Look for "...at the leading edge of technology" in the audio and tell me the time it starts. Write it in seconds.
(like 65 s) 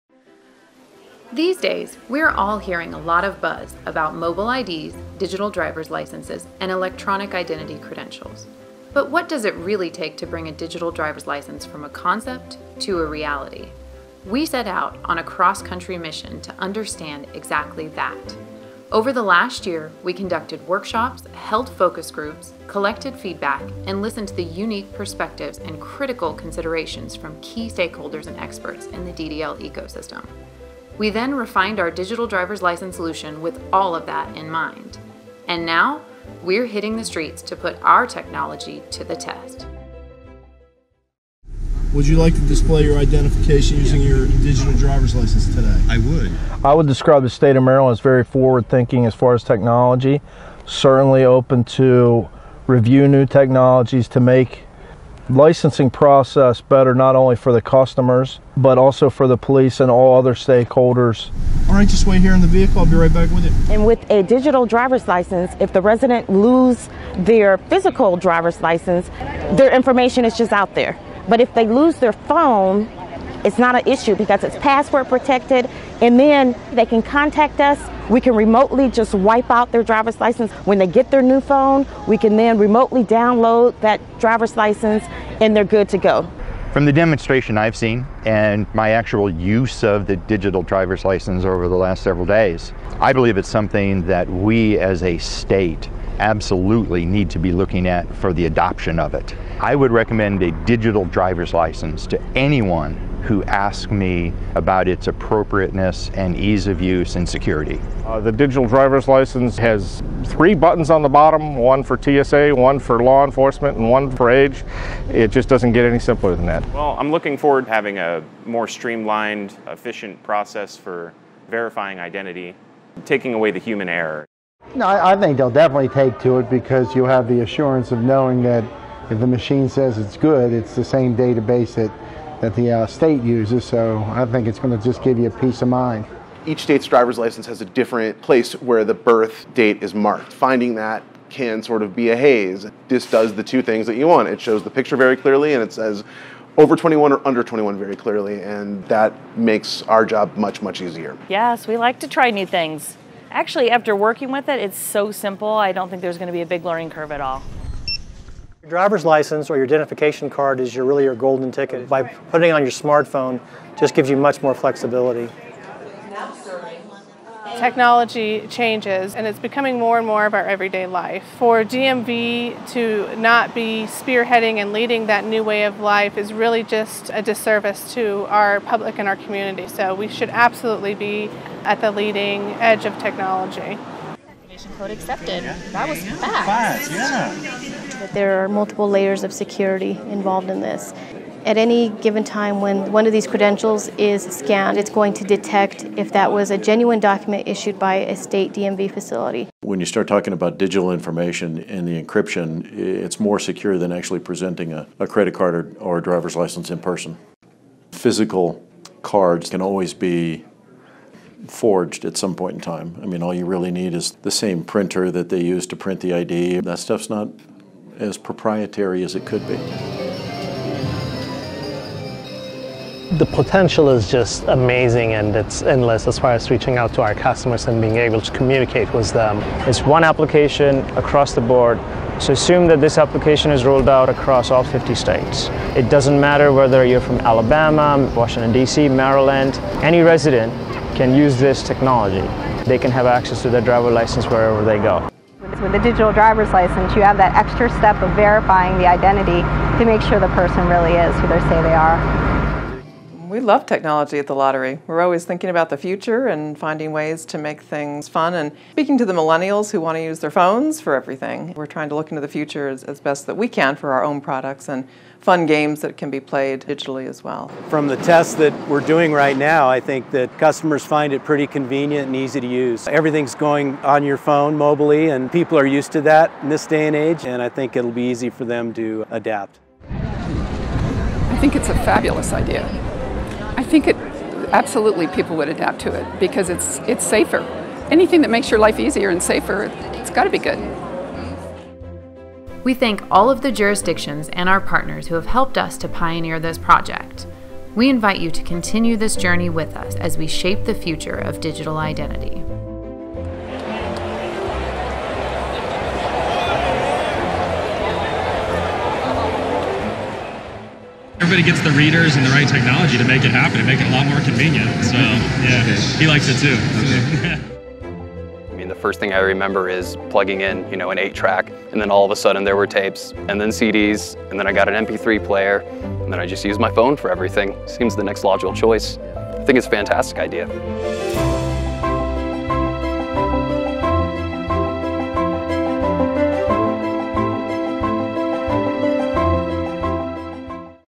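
181 s.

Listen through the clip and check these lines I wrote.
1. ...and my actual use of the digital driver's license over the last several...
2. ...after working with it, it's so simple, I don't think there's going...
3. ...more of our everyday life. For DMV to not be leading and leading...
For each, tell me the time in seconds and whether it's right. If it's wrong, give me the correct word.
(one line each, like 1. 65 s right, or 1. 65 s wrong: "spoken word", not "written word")
1. 88 s right
2. 153 s right
3. 170 s wrong: "spearheading", not "leading".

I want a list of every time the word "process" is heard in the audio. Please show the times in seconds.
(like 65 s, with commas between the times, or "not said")
55 s, 120 s.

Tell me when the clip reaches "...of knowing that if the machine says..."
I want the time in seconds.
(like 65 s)
127 s.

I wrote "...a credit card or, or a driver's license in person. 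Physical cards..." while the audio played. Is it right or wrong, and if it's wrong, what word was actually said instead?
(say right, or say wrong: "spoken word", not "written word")
right.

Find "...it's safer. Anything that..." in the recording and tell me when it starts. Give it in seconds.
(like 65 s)
286 s.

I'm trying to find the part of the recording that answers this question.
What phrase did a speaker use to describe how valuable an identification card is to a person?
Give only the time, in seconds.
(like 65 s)
161 s.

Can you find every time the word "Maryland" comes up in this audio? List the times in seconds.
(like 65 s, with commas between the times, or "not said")
47 s, 238 s.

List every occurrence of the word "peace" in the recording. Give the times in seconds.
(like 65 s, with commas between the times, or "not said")
135 s.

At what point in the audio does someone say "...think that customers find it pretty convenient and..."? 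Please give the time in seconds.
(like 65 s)
269 s.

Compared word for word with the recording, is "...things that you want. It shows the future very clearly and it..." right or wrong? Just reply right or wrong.
wrong.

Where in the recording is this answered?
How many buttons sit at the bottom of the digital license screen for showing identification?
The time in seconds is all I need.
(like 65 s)
110 s.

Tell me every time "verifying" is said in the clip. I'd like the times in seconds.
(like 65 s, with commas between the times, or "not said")
121 s, 248 s.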